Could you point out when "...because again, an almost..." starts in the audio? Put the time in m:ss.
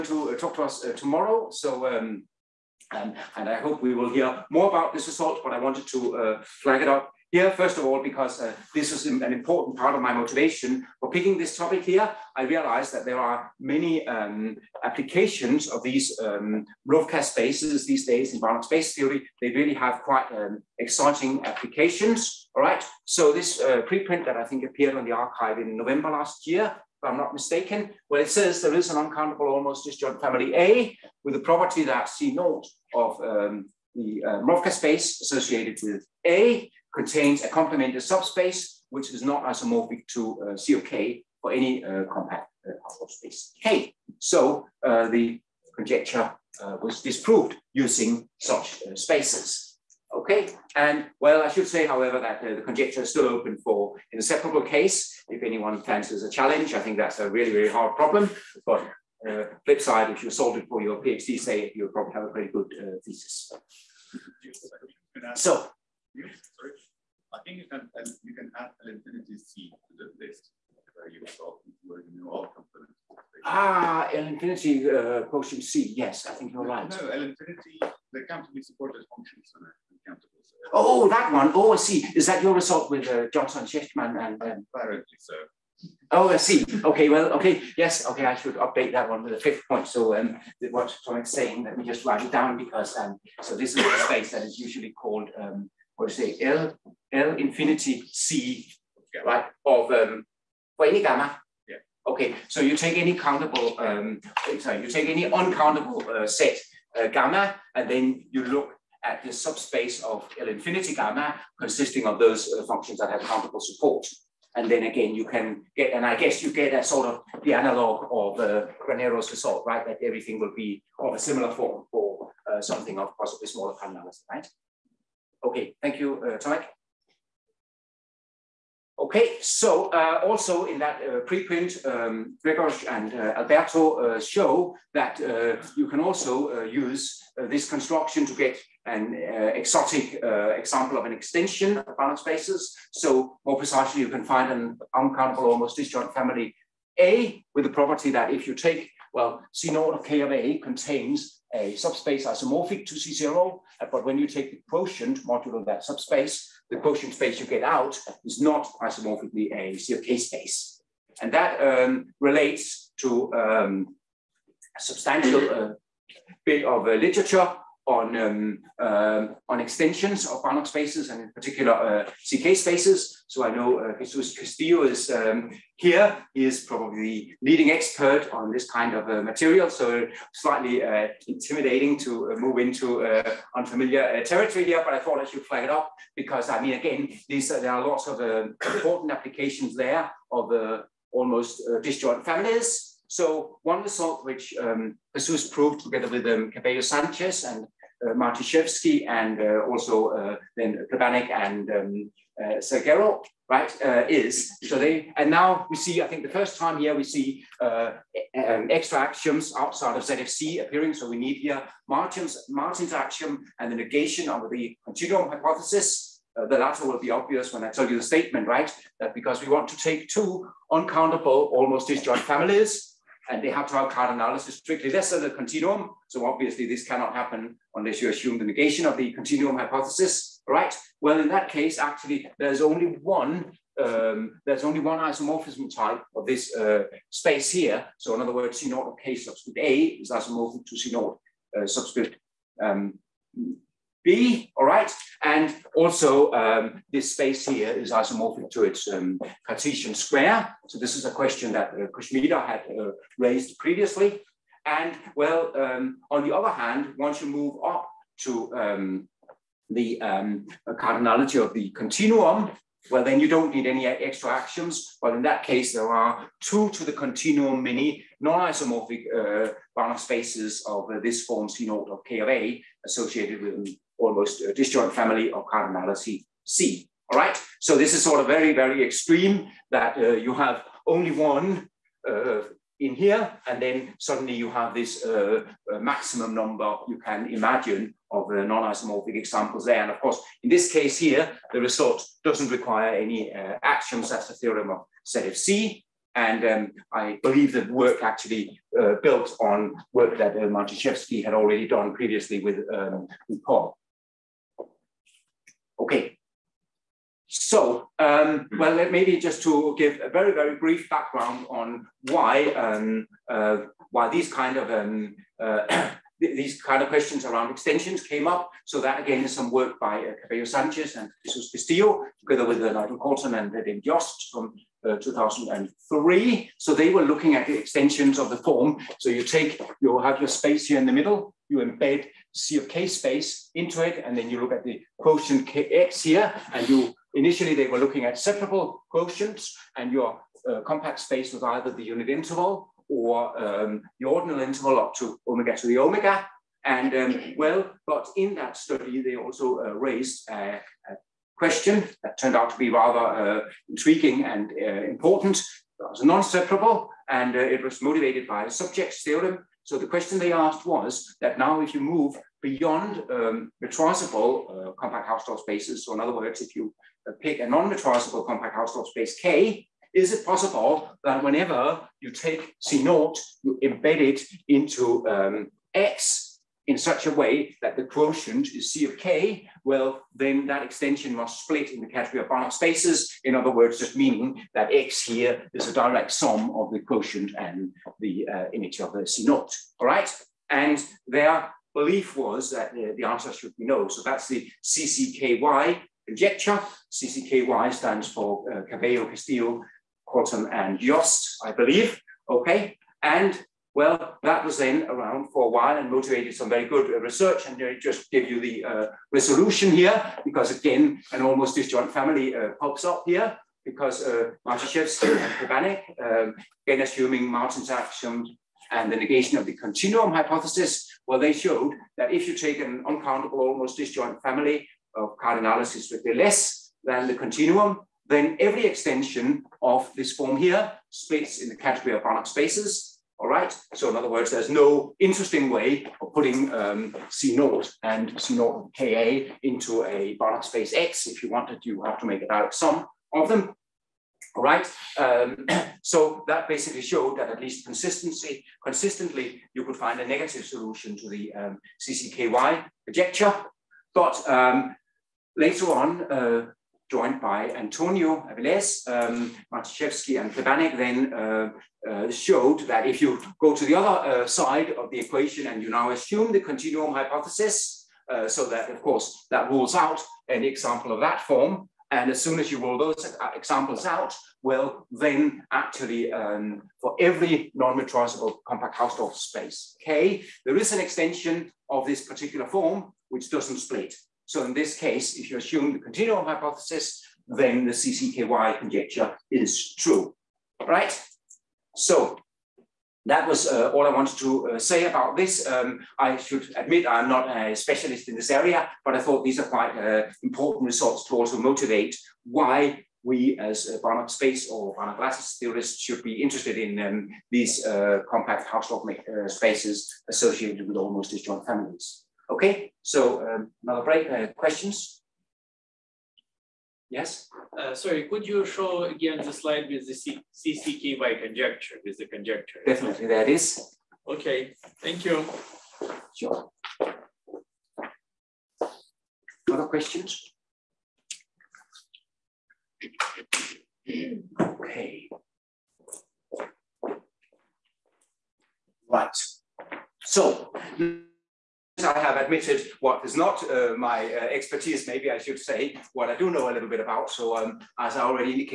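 6:50.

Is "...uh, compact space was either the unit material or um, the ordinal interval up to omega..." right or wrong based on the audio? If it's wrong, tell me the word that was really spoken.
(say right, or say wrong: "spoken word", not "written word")
wrong: "interval", not "material".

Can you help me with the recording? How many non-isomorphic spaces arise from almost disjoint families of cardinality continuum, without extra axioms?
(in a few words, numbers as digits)
Two to the continuum.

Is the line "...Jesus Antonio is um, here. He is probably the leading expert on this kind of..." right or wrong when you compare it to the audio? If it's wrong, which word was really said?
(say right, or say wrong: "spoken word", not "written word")
wrong: "Castillo", not "Antonio".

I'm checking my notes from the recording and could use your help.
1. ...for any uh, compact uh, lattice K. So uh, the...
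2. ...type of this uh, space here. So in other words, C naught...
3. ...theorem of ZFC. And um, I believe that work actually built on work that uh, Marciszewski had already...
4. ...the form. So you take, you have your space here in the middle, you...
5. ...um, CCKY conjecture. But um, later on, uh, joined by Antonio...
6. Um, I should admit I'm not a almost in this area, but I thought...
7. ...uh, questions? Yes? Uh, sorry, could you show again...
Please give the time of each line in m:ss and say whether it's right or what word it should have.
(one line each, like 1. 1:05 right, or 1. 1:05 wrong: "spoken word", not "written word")
1. 0:41 wrong: "space", not "lattice"
2. 3:55 right
3. 4:54 right
4. 5:28 right
5. 7:31 right
6. 8:15 wrong: "specialist", not "almost"
7. 8:34 right.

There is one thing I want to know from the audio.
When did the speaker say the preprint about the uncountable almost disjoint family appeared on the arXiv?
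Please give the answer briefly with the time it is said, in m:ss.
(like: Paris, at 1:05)
November last year, at 0:25.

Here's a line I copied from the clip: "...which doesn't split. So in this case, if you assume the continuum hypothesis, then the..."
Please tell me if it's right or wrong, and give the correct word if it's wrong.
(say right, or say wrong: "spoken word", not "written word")
right.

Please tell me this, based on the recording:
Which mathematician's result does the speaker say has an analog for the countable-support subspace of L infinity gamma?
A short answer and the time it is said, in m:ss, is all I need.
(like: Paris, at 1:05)
Granero, at 1:58.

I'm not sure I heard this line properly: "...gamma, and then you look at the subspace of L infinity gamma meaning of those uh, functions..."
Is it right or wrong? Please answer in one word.
wrong.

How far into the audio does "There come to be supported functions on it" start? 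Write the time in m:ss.
1:18.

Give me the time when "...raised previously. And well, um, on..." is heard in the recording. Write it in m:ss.
4:13.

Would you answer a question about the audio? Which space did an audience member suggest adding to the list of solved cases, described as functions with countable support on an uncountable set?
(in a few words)
L infinity C.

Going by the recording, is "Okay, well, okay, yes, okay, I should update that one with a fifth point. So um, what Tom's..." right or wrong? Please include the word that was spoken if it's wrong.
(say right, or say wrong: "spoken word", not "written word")
right.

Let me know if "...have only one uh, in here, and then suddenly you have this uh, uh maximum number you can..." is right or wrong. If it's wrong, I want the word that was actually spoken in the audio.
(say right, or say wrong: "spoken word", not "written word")
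right.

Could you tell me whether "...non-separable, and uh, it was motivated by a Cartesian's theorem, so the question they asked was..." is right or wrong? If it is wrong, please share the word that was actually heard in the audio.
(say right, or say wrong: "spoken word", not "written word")
wrong: "Sobczyk", not "Cartesian".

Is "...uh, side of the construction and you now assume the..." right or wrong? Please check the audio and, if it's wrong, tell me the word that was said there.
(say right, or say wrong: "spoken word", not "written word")
wrong: "equation", not "construction".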